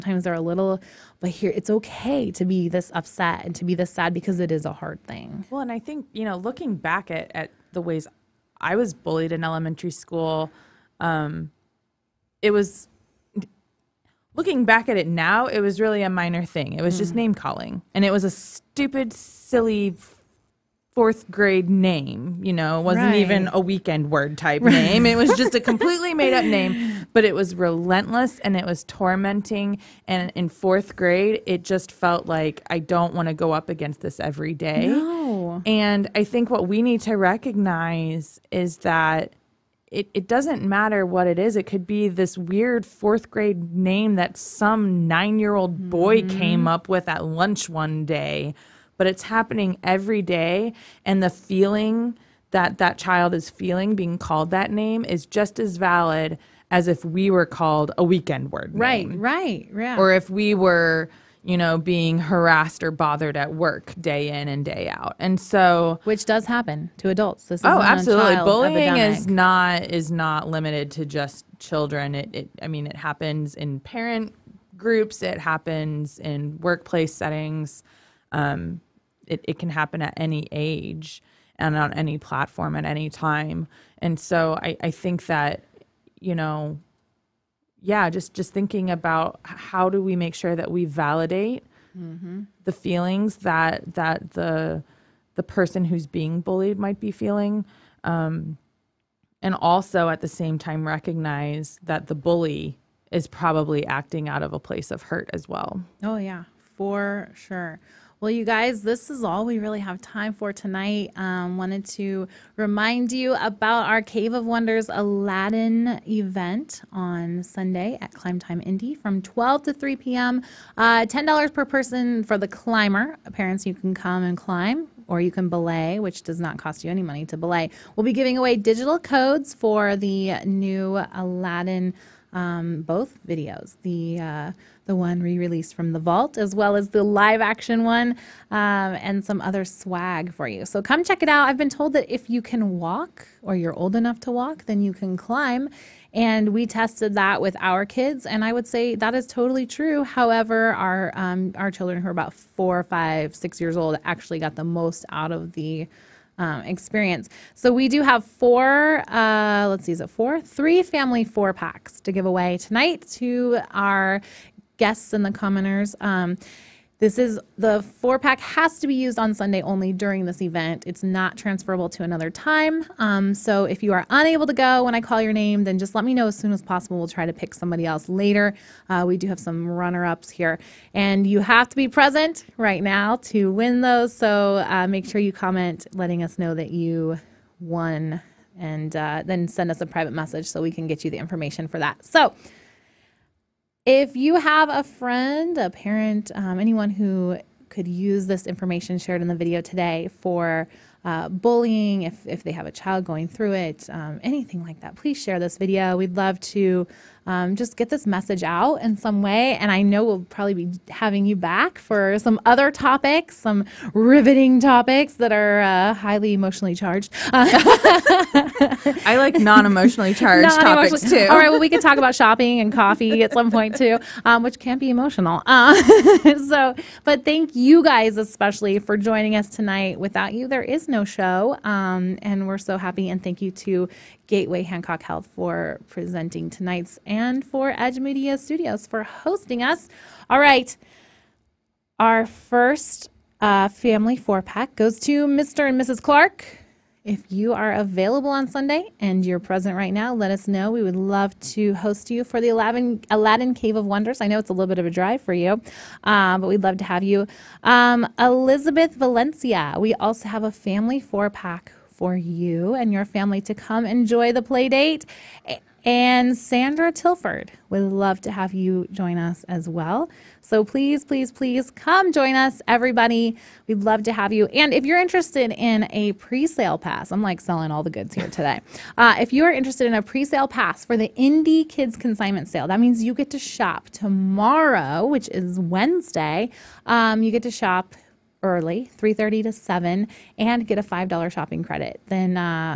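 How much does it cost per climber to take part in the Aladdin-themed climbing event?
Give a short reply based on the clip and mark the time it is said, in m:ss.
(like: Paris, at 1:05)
$10, at 2:01.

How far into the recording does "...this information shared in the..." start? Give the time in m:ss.
3:18.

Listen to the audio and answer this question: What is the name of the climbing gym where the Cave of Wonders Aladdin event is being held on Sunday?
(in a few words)
Climb Time Indy.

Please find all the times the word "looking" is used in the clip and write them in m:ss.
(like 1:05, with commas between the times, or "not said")
0:06, 0:14.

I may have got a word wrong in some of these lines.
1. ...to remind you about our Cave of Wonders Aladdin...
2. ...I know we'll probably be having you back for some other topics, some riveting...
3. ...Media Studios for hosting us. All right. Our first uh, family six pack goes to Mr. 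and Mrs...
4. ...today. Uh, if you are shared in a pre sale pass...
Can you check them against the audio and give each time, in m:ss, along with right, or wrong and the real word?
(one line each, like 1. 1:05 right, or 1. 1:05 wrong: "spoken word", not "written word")
1. 1:51 right
2. 3:29 right
3. 3:57 wrong: "four", not "six"
4. 4:38 wrong: "interested", not "shared".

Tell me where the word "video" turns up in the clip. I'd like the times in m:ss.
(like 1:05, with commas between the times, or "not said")
2:13, 3:19, 3:25.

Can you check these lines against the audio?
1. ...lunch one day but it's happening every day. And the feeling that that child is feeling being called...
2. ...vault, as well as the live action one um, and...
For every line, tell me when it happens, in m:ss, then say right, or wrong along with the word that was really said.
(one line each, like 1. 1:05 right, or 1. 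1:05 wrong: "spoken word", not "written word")
1. 0:47 right
2. 2:15 right.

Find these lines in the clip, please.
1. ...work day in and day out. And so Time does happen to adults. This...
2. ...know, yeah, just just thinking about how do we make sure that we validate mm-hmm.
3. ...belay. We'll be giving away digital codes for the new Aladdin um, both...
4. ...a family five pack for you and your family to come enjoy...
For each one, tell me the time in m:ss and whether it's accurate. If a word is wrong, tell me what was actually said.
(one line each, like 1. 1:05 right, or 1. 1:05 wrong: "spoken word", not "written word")
1. 1:03 wrong: "Which", not "Time"
2. 1:26 right
3. 2:07 right
4. 4:20 wrong: "four", not "five".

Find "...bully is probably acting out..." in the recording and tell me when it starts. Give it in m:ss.
1:42.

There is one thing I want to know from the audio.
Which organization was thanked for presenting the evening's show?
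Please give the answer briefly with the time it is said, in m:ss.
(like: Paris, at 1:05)
Gateway Hancock Health, at 3:54.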